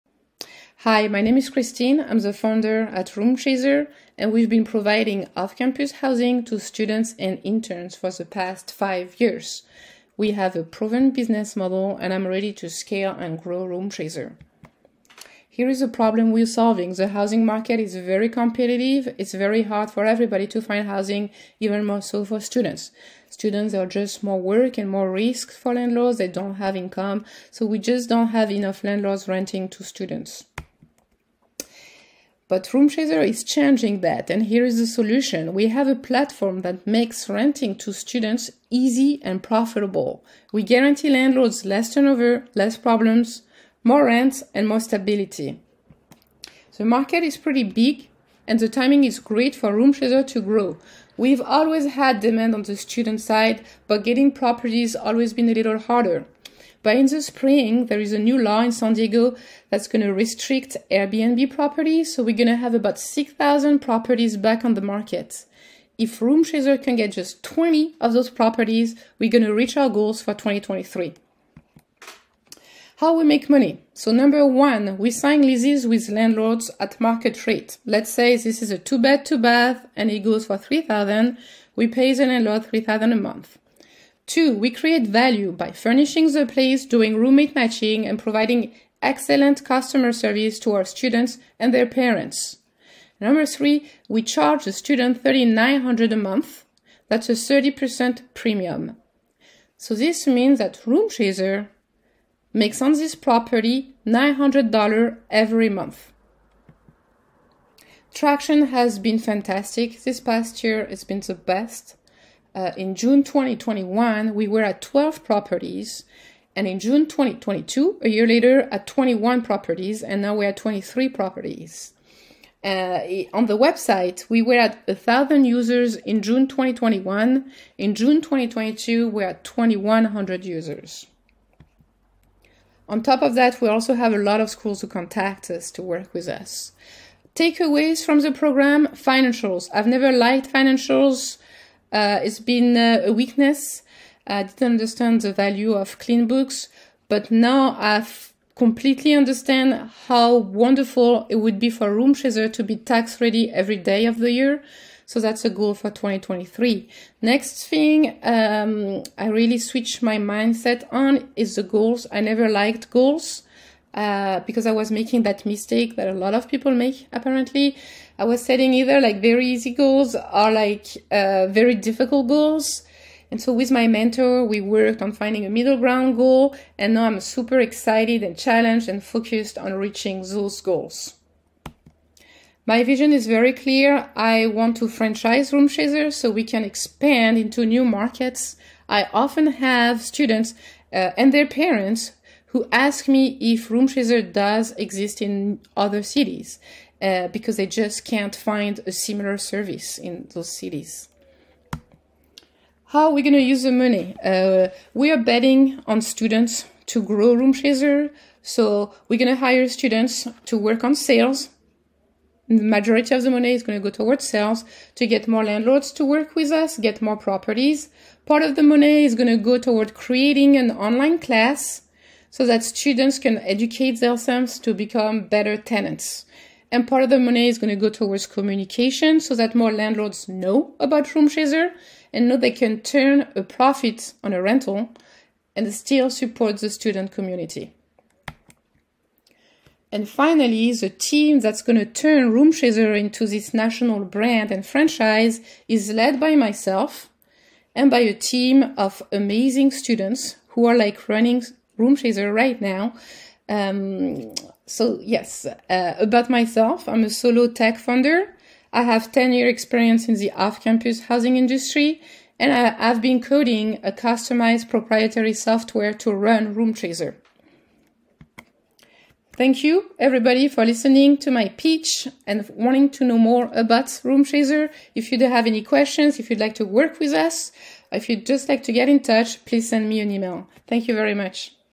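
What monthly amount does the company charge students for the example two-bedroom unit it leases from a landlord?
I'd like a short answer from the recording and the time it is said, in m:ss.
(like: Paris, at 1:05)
$3,900, at 1:35.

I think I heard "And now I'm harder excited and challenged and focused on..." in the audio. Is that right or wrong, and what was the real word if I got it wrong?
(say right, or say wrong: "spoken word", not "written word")
wrong: "super", not "harder".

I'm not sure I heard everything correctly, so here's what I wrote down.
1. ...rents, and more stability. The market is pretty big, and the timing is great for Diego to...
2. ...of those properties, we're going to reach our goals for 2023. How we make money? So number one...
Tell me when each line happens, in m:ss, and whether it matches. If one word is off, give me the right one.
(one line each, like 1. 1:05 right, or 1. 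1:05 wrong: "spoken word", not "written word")
1. 0:44 wrong: "RoomChazer", not "Diego"
2. 1:08 right.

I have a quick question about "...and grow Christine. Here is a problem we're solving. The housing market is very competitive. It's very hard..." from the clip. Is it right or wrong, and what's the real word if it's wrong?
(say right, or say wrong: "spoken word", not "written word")
wrong: "RoomChazer", not "Christine".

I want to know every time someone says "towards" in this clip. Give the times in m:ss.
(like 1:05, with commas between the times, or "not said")
3:33, 3:39, 3:47.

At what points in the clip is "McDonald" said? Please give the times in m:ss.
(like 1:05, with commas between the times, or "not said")
not said.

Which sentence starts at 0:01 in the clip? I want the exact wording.
I'm the founder at RoomChazer, and we've been providing off campus housing to students and interns for the past five years.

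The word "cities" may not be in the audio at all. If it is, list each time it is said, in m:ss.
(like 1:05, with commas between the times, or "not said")
3:16, 3:20.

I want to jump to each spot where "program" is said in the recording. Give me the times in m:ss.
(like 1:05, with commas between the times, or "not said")
2:18.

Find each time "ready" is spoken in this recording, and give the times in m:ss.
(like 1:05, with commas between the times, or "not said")
0:12, 2:33.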